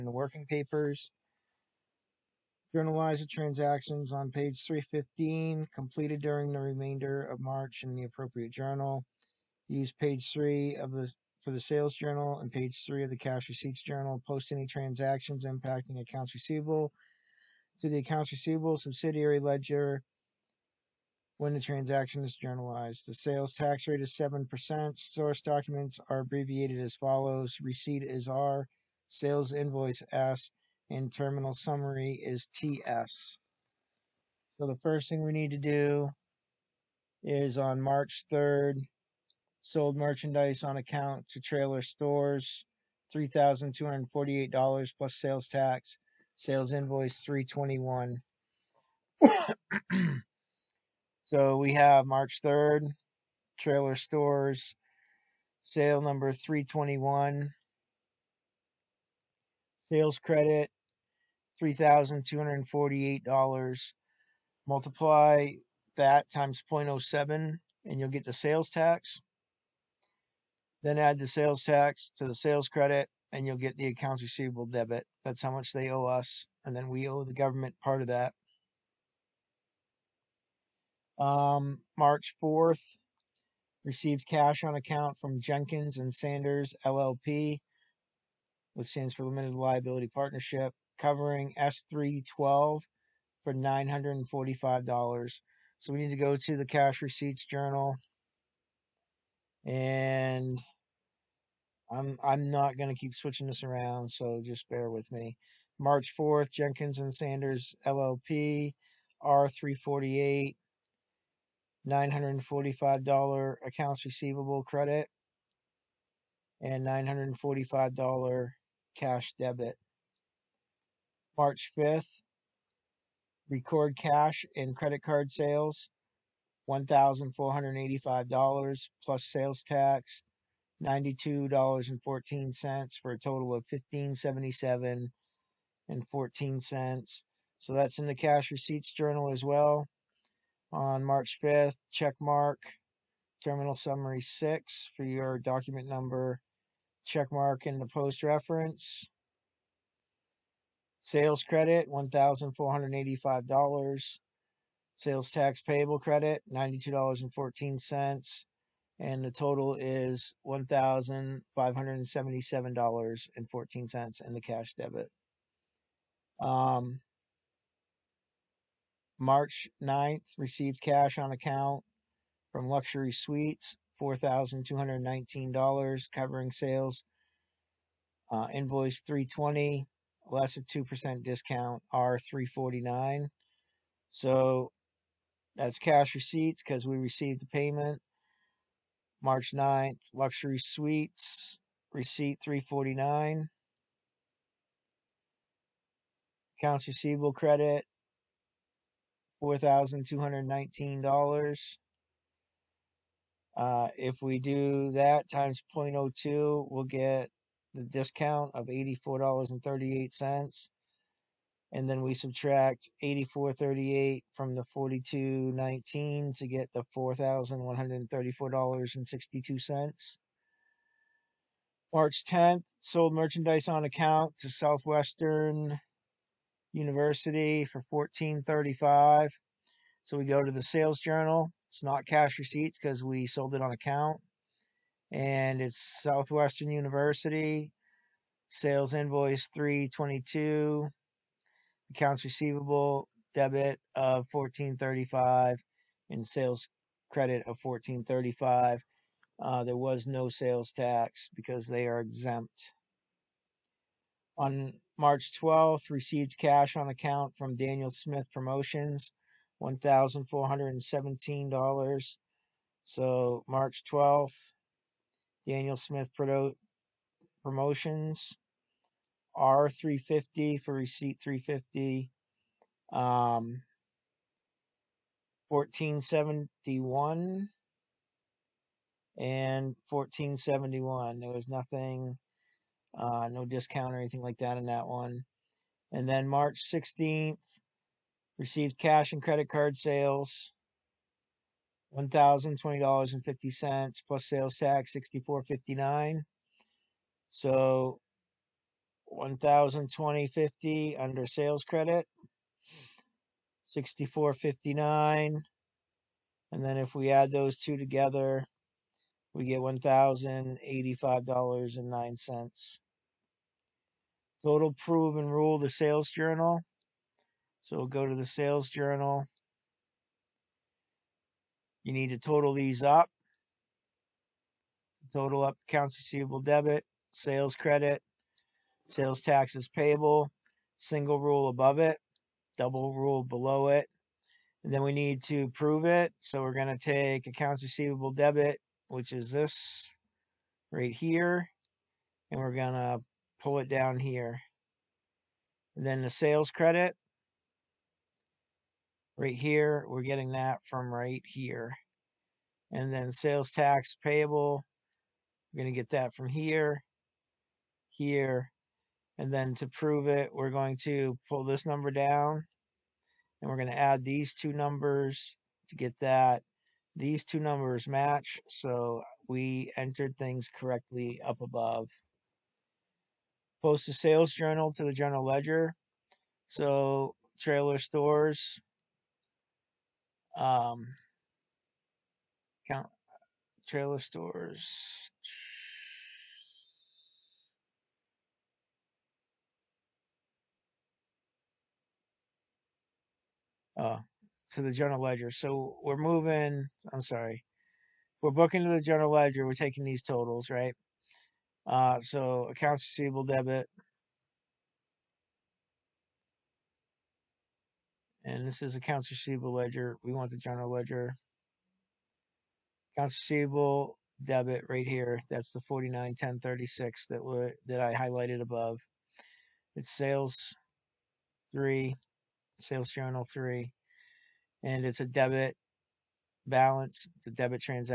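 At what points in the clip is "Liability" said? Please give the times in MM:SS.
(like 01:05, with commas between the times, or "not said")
01:29.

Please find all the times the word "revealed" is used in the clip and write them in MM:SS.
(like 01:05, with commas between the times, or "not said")
not said.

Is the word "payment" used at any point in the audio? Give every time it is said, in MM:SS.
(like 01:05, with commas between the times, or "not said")
03:07.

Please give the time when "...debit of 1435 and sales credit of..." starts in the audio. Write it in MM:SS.
04:03.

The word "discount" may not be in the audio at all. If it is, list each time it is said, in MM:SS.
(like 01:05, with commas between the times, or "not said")
03:01, 03:27, 04:43.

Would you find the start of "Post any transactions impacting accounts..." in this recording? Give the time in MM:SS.
00:14.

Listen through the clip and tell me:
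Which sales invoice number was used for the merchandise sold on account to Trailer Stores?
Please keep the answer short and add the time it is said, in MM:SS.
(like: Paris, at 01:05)
321, at 00:46.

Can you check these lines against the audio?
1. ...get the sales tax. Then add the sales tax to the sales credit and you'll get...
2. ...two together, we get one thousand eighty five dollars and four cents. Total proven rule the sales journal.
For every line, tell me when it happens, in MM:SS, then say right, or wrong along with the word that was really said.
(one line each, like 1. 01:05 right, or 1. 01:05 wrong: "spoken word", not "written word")
1. 01:08 right
2. 05:07 wrong: "nine", not "four".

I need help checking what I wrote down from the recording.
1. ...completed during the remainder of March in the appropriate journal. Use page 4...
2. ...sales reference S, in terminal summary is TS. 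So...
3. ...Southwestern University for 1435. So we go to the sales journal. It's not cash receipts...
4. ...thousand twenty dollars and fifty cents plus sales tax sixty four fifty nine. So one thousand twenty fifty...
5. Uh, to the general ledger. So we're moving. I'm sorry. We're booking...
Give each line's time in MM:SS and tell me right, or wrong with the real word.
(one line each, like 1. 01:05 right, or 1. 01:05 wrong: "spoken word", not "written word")
1. 00:05 wrong: "3", not "4"
2. 00:29 wrong: "invoice", not "reference"
3. 03:44 right
4. 04:52 right
5. 06:33 right.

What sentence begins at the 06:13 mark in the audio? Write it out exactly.
Post a sales journal to the general ledger.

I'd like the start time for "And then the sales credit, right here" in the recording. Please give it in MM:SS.
05:45.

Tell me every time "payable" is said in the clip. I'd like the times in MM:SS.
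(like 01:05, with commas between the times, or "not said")
05:29, 05:54.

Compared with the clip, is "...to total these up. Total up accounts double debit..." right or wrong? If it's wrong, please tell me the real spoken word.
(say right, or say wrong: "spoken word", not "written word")
wrong: "receivable", not "double".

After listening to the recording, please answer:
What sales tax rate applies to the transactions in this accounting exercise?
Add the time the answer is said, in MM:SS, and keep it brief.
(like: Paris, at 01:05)
7%, at 00:24.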